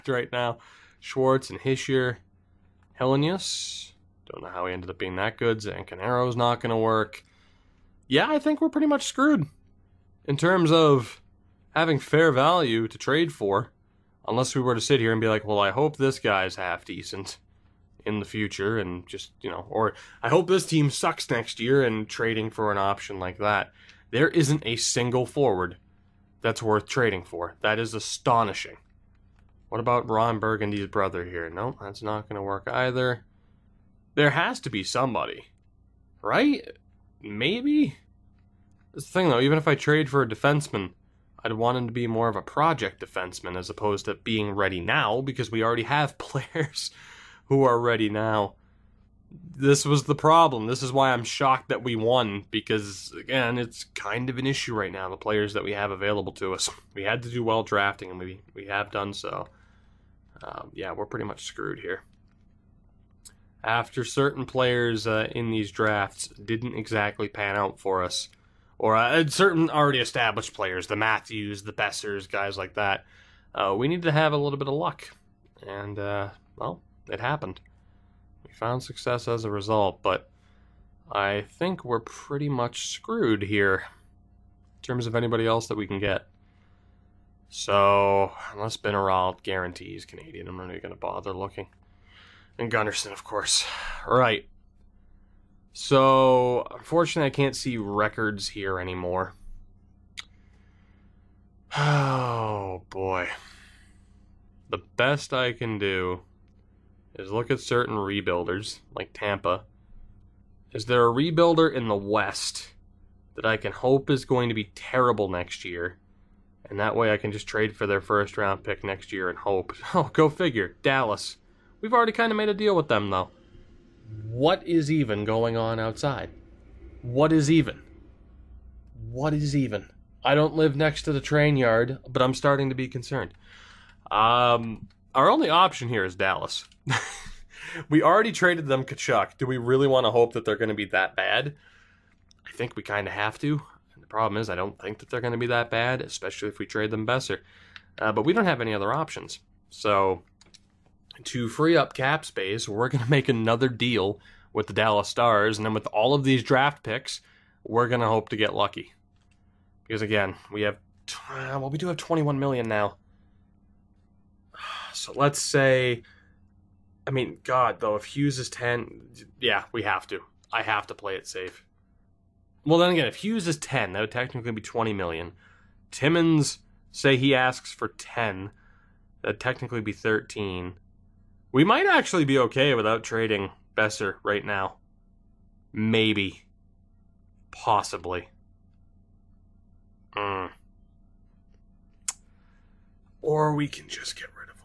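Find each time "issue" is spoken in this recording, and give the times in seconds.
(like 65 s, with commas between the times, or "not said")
54 s.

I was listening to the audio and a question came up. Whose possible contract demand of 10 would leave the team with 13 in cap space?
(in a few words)
Timmons.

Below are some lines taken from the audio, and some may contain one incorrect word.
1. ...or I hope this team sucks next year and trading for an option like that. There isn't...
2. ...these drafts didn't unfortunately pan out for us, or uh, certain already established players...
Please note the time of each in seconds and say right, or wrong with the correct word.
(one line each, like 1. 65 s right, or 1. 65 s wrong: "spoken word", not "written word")
1. 19 s right
2. 65 s wrong: "exactly", not "unfortunately".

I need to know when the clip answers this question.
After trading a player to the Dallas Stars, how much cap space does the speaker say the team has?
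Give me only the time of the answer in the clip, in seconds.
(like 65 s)
161 s.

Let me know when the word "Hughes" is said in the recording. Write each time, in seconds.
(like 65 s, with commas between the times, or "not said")
168 s, 173 s.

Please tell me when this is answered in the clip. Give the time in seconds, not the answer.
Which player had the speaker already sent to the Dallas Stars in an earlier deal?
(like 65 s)
138 s.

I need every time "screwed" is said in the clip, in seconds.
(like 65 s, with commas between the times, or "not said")
9 s, 61 s, 82 s.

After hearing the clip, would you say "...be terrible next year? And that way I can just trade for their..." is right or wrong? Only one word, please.
right.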